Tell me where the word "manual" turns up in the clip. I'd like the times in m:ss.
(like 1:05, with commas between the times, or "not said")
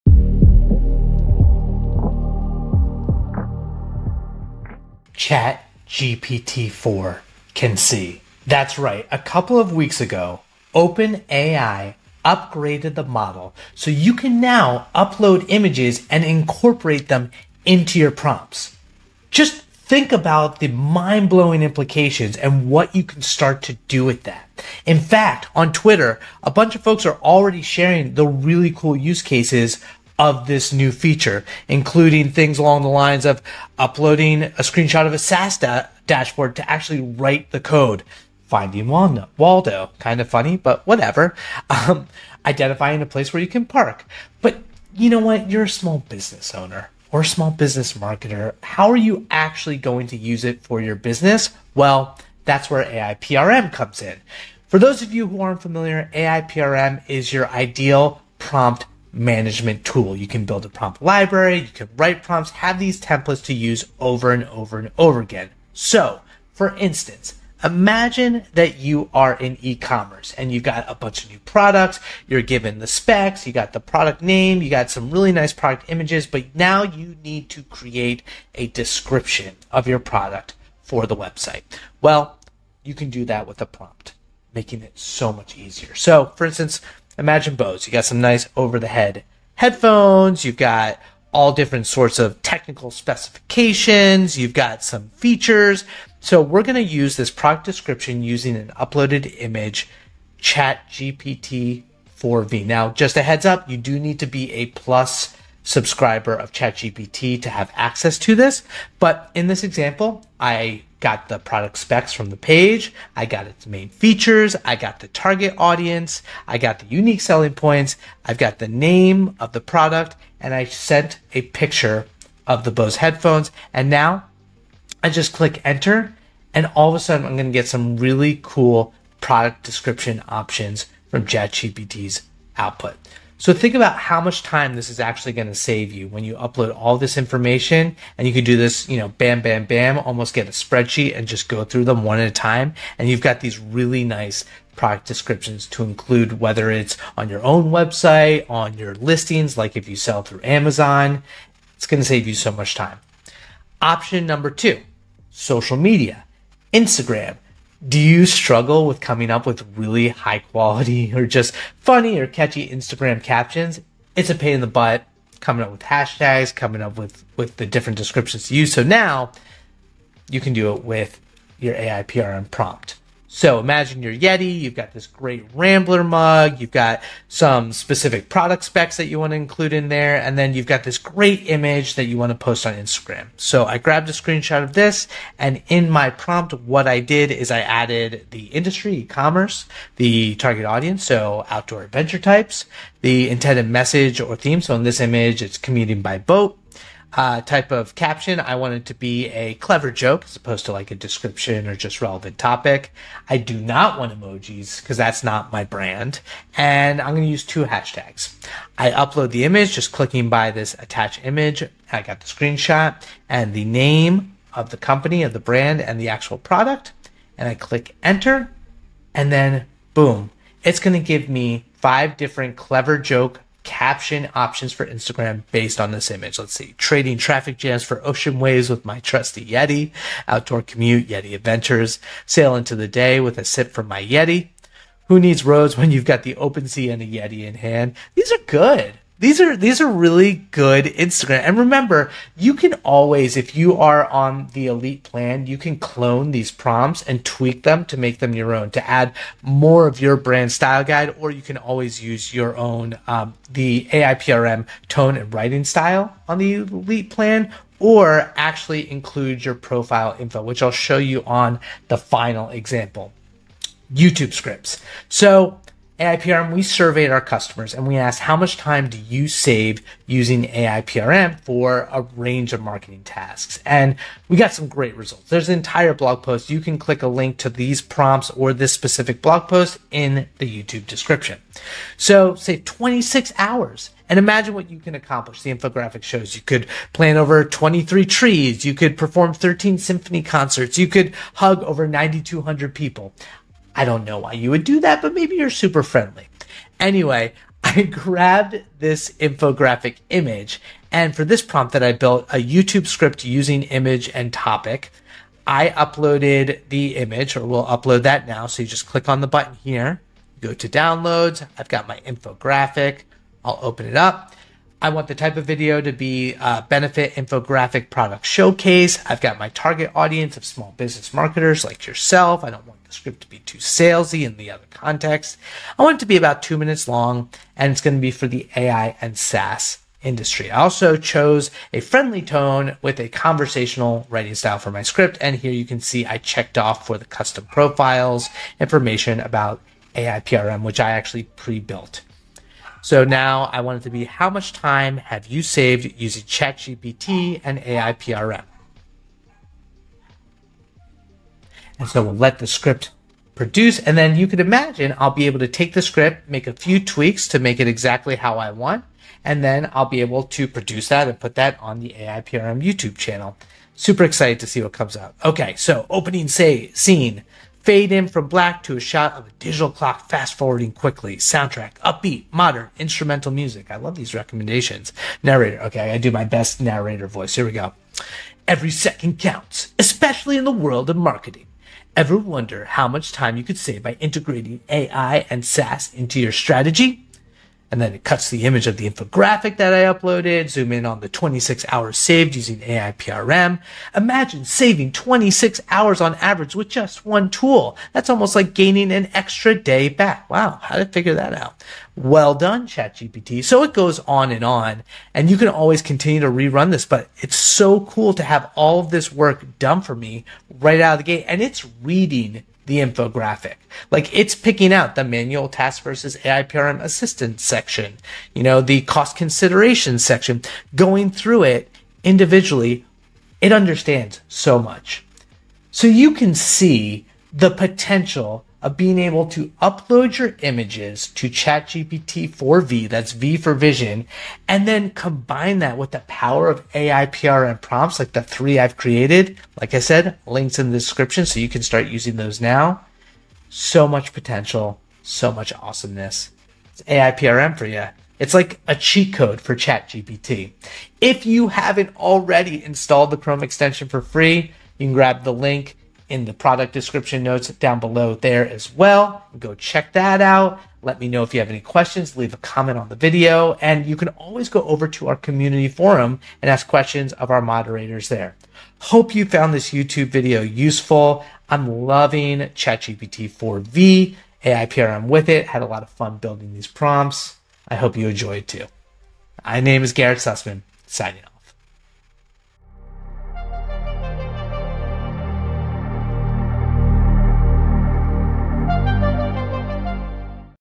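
6:55.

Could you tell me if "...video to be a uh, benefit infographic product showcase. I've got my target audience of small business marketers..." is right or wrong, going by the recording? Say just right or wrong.
right.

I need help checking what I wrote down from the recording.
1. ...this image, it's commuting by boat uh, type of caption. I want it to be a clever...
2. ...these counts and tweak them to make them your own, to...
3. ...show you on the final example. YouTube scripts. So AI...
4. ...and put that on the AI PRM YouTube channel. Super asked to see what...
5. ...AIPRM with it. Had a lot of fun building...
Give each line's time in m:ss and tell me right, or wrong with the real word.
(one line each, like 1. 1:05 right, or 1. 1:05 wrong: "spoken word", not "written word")
1. 3:14 right
2. 4:06 wrong: "prompts", not "counts"
3. 4:20 right
4. 6:01 wrong: "excited", not "asked"
5. 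7:54 right.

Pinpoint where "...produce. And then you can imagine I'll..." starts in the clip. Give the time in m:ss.
5:53.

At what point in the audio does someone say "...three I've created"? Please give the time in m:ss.
7:18.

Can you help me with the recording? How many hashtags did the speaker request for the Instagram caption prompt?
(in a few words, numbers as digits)
2.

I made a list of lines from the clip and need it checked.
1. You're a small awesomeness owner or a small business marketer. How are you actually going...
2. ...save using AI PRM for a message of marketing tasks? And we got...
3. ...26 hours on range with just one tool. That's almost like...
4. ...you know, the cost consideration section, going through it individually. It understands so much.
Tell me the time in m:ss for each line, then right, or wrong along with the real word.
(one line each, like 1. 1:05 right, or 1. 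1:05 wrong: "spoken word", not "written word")
1. 0:45 wrong: "business", not "awesomeness"
2. 4:29 wrong: "range", not "message"
3. 6:34 wrong: "average", not "range"
4. 6:58 right.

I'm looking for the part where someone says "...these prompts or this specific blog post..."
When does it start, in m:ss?
4:37.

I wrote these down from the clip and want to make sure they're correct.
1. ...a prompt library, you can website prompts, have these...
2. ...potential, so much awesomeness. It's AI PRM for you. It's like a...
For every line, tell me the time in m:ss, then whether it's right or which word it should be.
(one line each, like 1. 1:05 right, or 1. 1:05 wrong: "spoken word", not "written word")
1. 1:00 wrong: "write", not "website"
2. 7:24 right.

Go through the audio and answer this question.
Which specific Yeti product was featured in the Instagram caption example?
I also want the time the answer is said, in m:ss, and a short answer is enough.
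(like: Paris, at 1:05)
Rambler mug, at 2:55.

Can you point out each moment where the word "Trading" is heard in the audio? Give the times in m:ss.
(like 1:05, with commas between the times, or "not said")
3:46.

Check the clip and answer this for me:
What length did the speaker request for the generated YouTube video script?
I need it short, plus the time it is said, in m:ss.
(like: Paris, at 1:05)
2 minutes, at 5:26.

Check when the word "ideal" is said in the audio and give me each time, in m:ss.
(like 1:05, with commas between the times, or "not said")
0:57.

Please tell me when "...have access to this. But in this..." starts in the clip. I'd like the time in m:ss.
1:47.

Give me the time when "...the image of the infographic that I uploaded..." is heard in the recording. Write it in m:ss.
6:28.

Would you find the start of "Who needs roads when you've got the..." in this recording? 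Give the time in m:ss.
3:55.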